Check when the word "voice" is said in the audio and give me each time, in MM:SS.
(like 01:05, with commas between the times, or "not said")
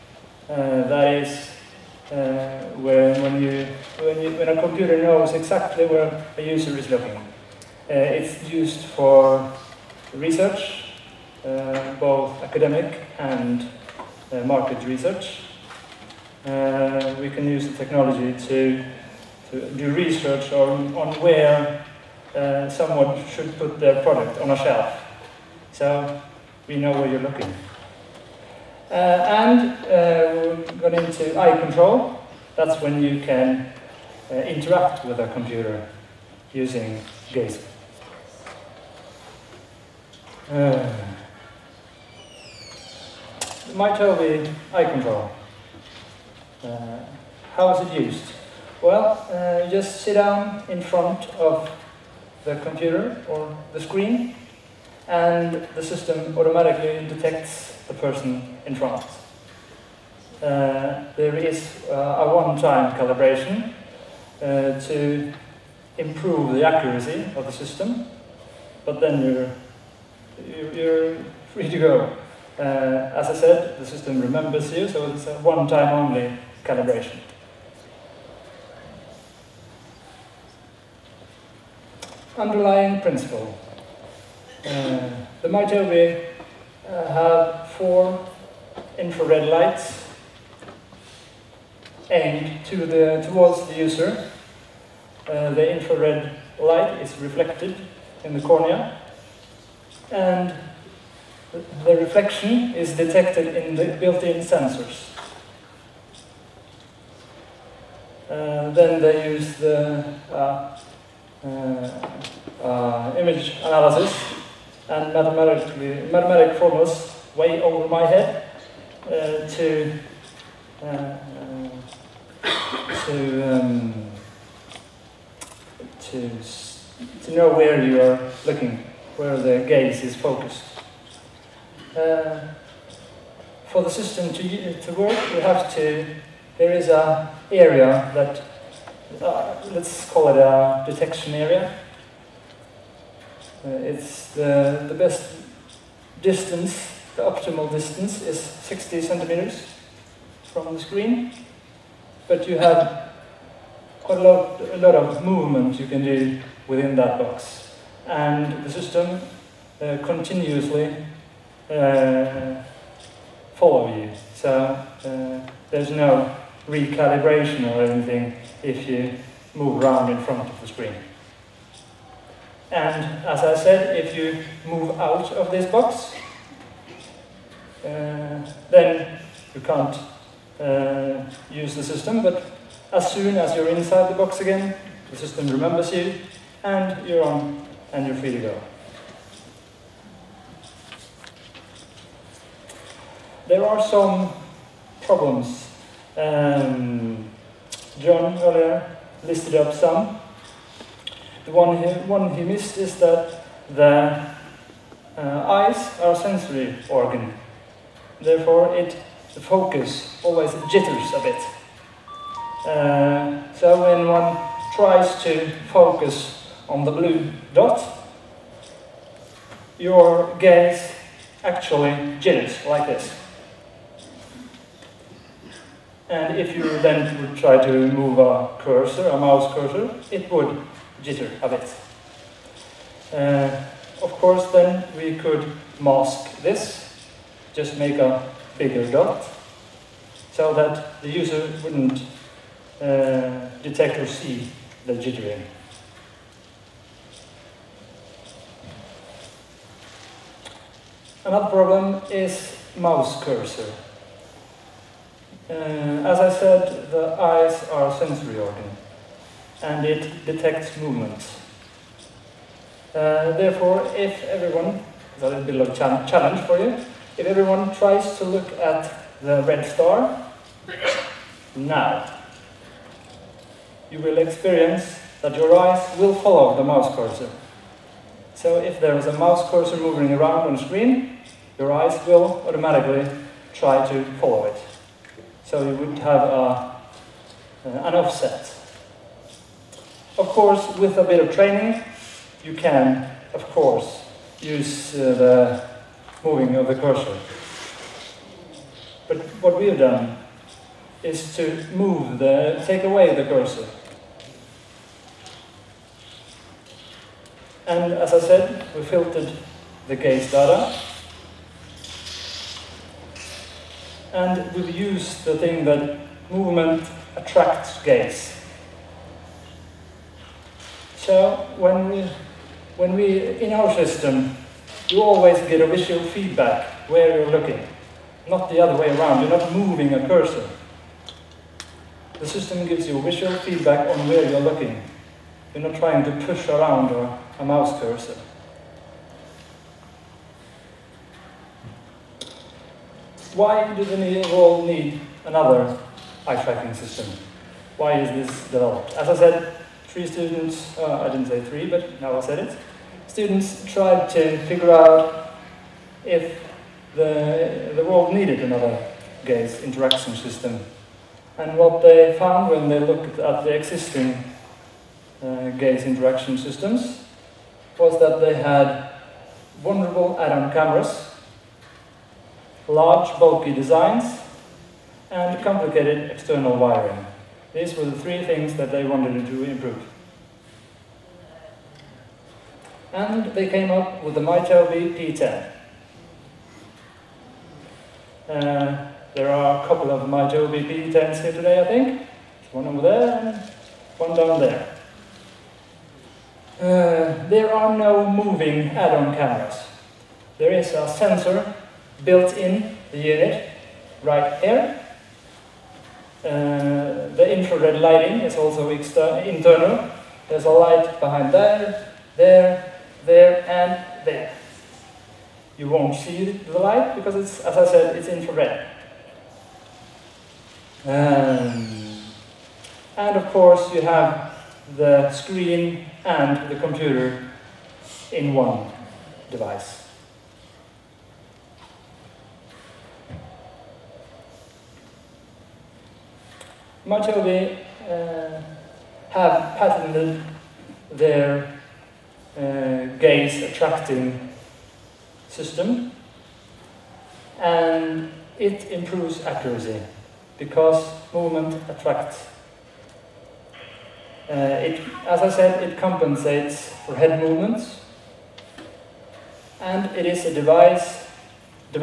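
not said.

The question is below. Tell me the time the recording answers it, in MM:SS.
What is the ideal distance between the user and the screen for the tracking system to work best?
02:28.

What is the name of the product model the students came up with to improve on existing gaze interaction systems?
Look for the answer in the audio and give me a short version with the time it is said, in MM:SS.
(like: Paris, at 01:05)
MyTobii P10, at 06:24.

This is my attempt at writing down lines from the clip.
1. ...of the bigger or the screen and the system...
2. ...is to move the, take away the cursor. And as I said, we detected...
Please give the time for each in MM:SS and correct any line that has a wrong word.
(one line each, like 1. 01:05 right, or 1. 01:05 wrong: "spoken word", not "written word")
1. 00:51 wrong: "computer", not "bigger"
2. 05:01 wrong: "filtered", not "detected".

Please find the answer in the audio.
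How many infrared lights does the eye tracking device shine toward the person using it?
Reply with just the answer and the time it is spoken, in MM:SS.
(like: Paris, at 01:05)
4, at 01:27.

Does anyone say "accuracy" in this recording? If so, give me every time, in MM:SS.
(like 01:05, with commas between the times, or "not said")
01:06, 07:29.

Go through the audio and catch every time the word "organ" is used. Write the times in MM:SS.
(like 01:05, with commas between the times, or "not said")
03:26, 04:18.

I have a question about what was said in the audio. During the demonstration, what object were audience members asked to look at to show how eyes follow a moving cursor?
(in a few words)
Red star.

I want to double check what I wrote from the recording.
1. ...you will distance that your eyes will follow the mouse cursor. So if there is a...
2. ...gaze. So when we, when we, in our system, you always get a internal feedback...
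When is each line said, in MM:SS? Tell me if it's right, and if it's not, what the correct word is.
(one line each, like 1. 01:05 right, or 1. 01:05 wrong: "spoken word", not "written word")
1. 04:33 wrong: "experience", not "distance"
2. 05:17 wrong: "visual", not "internal".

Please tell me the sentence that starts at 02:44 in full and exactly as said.
So uh, there's no recalibration or anything if you move around in front of the screen.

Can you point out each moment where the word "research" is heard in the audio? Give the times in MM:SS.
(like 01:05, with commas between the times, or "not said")
00:10, 00:14, 00:19.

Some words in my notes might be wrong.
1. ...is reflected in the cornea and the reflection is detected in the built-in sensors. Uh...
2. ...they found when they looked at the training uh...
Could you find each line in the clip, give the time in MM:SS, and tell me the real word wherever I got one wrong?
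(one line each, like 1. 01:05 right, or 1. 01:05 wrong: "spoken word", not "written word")
1. 01:37 right
2. 06:01 wrong: "existing", not "training".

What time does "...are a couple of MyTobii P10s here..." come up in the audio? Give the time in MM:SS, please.
06:29.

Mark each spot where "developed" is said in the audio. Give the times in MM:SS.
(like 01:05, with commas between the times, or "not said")
05:48.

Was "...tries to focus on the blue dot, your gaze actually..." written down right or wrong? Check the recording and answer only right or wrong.
right.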